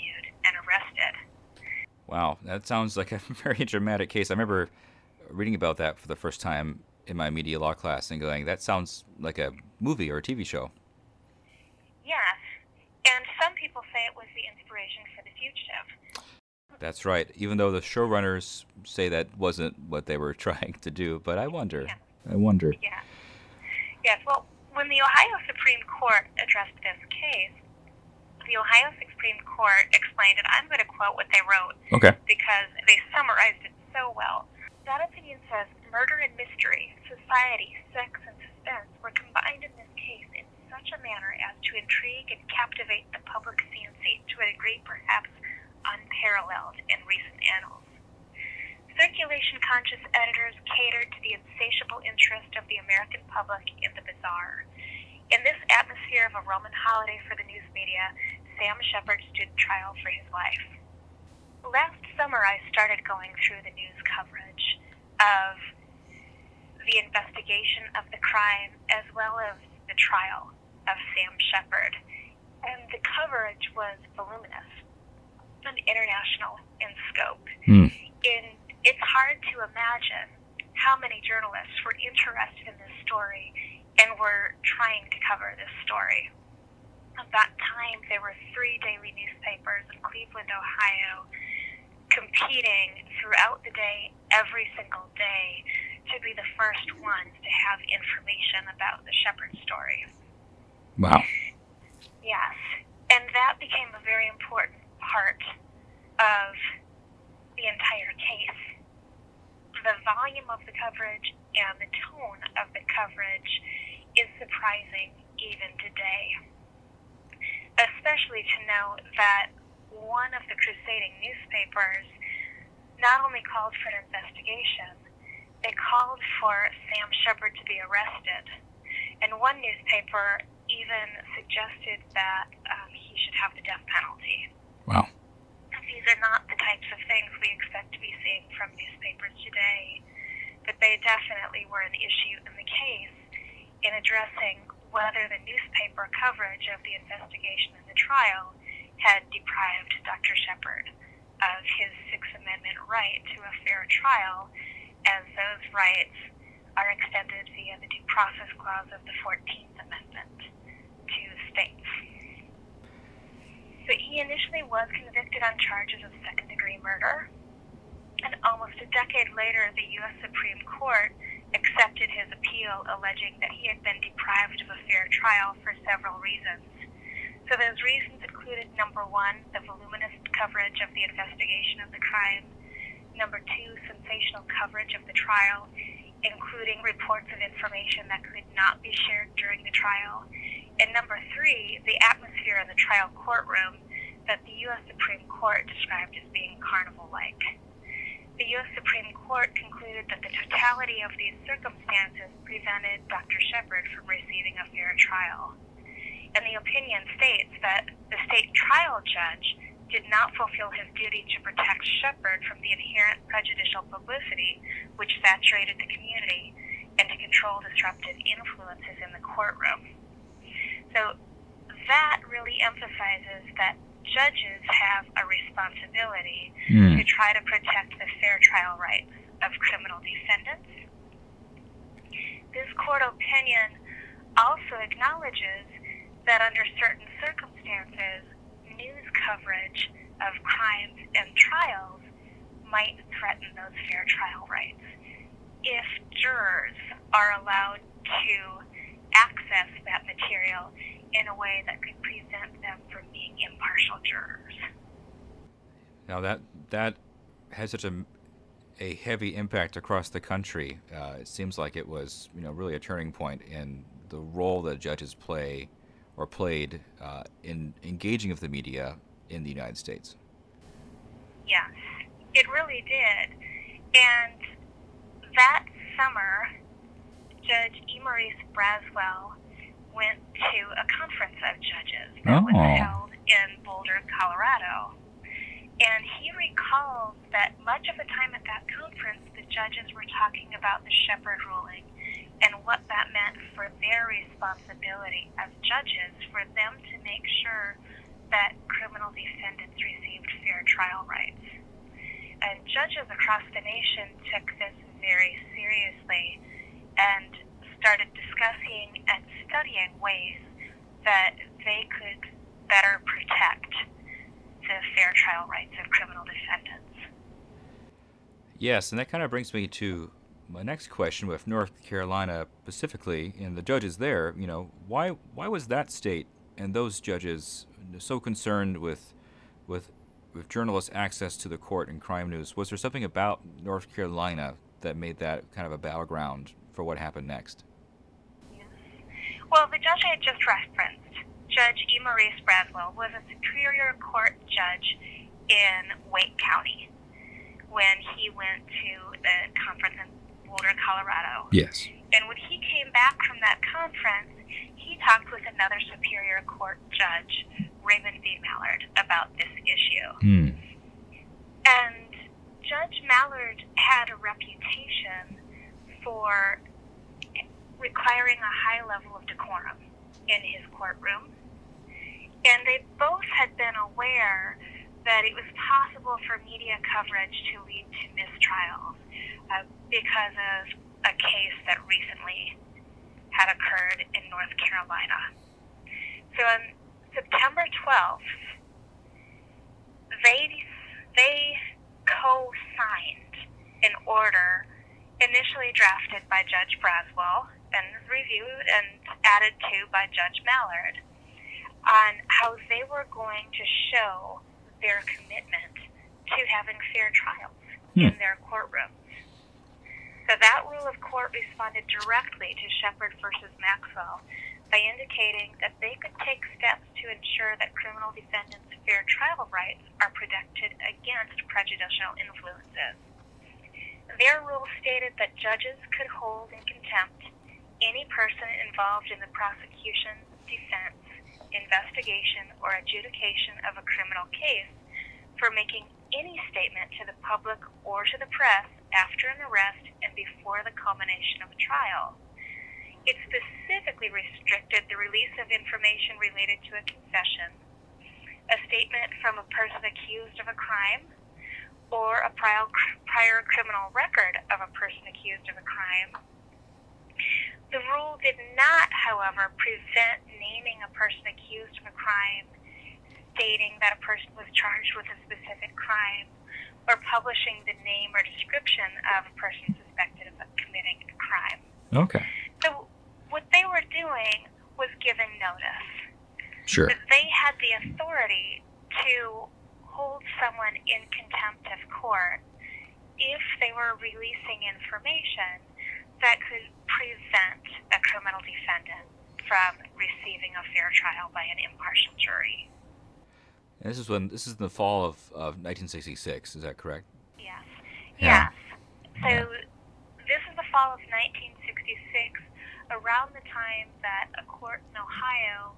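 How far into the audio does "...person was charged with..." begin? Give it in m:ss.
7:43.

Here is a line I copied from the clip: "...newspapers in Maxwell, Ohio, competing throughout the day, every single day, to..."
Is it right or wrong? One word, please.
wrong.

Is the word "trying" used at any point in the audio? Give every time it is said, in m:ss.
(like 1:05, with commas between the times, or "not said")
0:20, 1:24.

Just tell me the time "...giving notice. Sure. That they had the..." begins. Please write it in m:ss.
7:55.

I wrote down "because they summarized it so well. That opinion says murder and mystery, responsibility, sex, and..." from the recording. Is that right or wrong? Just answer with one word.
wrong.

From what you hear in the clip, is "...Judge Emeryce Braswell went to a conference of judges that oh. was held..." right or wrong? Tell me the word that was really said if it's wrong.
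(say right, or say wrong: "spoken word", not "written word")
right.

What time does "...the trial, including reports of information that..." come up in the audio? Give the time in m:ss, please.
3:05.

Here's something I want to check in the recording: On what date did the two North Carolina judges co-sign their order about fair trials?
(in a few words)
September 12.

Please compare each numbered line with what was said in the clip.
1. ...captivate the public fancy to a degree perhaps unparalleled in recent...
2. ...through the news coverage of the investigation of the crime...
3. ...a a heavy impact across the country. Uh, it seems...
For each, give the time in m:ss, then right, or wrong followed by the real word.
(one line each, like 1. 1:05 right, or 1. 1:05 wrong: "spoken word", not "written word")
1. 0:42 right
2. 1:03 right
3. 4:17 right.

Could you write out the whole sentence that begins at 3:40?
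So that really emphasizes that judges have a responsibility mm.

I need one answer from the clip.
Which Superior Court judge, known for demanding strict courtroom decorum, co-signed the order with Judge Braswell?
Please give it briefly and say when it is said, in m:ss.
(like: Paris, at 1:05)
Raymond B. Mallard, at 5:57.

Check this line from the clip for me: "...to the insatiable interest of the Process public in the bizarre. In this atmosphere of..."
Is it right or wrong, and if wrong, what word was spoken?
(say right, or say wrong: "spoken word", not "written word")
wrong: "American", not "Process".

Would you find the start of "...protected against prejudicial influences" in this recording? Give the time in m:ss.
7:00.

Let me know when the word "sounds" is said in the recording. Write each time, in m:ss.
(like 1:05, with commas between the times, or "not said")
0:02, 0:08.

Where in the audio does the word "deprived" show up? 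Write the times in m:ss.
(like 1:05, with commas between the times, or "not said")
2:29, 2:54.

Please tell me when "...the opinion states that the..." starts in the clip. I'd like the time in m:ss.
3:26.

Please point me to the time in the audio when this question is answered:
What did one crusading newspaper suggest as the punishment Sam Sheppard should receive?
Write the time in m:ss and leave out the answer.
2:13.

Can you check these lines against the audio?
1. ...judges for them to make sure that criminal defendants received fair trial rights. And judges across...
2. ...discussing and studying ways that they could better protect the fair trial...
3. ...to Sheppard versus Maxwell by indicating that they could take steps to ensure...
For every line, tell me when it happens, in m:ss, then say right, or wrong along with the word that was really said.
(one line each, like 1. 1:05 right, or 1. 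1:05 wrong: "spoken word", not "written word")
1. 4:55 right
2. 5:08 right
3. 6:52 right.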